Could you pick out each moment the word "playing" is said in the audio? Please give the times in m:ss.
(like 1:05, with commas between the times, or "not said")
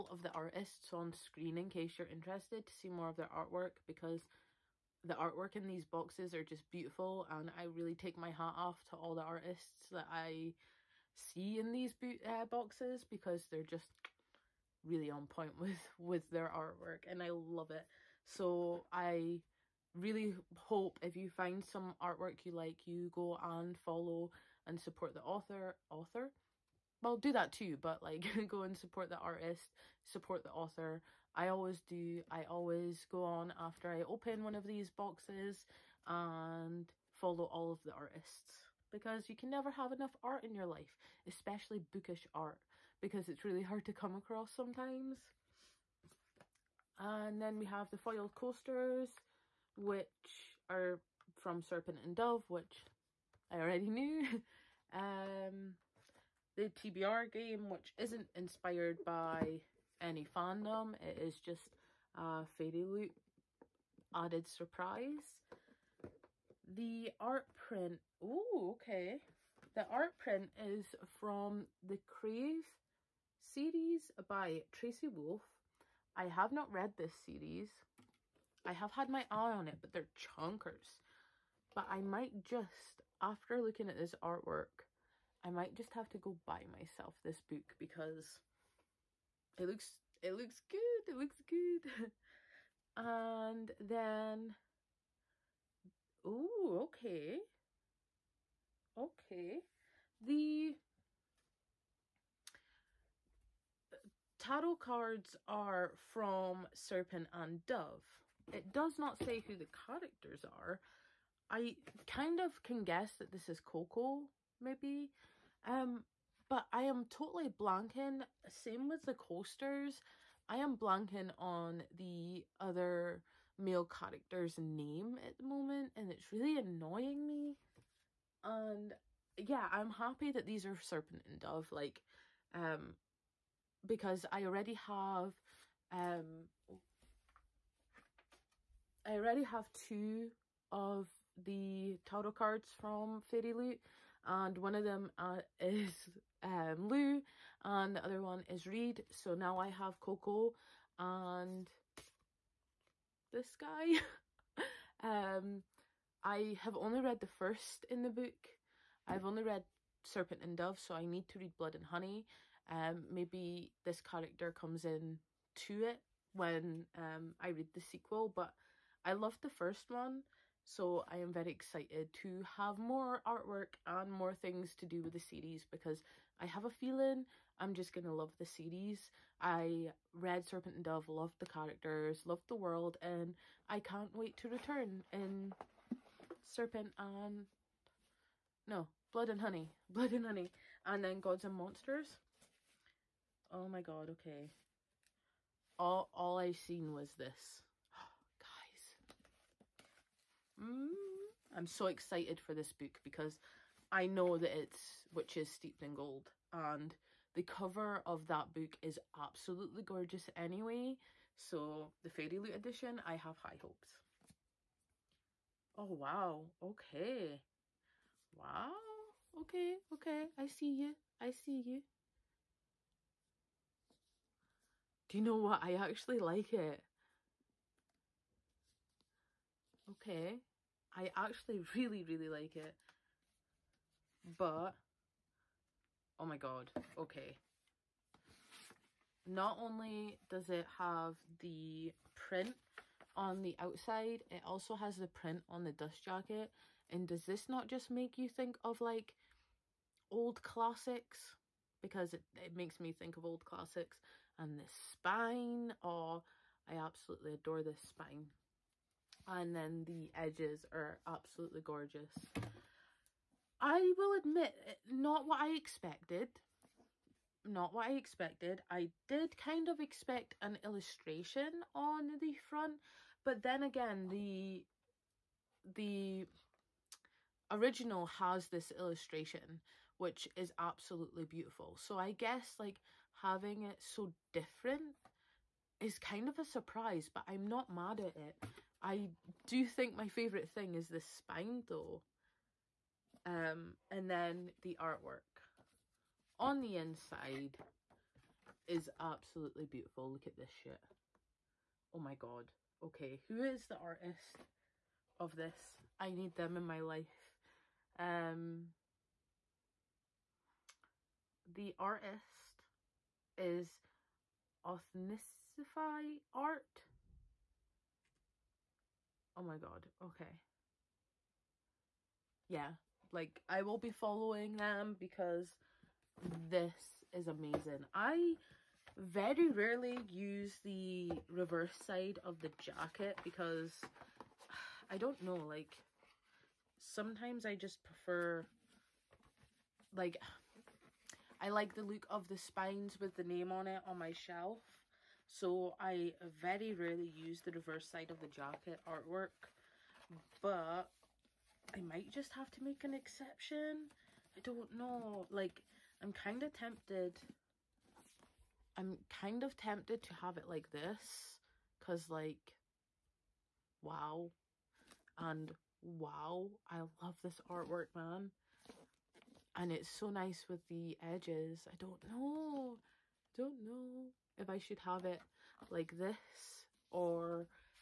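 not said.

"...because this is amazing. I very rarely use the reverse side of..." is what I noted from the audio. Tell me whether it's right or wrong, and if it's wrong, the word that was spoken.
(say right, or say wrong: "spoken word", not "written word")
right.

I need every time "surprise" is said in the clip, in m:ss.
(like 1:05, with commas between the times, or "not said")
1:04, 4:46.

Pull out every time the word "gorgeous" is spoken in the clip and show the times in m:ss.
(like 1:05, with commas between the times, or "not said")
3:29, 4:21.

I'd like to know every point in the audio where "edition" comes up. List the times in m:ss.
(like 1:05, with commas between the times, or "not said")
3:32.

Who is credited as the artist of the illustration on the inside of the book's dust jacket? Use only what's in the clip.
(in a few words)
Authnicify Art.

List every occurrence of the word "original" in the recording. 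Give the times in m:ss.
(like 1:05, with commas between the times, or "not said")
4:37.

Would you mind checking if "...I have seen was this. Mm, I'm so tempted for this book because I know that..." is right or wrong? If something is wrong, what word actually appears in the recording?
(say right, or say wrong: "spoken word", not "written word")
wrong: "excited", not "tempted".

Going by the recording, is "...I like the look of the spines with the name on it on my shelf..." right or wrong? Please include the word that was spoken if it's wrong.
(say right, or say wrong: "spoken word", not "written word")
right.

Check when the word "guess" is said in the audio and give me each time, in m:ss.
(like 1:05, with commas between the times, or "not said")
1:52, 4:42.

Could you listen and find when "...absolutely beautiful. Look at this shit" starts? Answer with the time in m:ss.
4:58.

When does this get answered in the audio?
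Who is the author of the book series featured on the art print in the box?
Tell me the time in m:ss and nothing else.
1:14.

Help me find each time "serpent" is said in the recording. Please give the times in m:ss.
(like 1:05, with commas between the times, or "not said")
0:51, 1:46, 2:10, 2:40, 3:00, 3:06.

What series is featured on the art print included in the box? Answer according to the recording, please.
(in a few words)
Crave.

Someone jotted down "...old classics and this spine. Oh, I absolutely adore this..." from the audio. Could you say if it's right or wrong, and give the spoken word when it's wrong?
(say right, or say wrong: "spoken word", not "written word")
right.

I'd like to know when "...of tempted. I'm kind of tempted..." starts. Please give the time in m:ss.
5:56.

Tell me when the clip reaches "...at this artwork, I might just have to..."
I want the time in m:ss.
1:23.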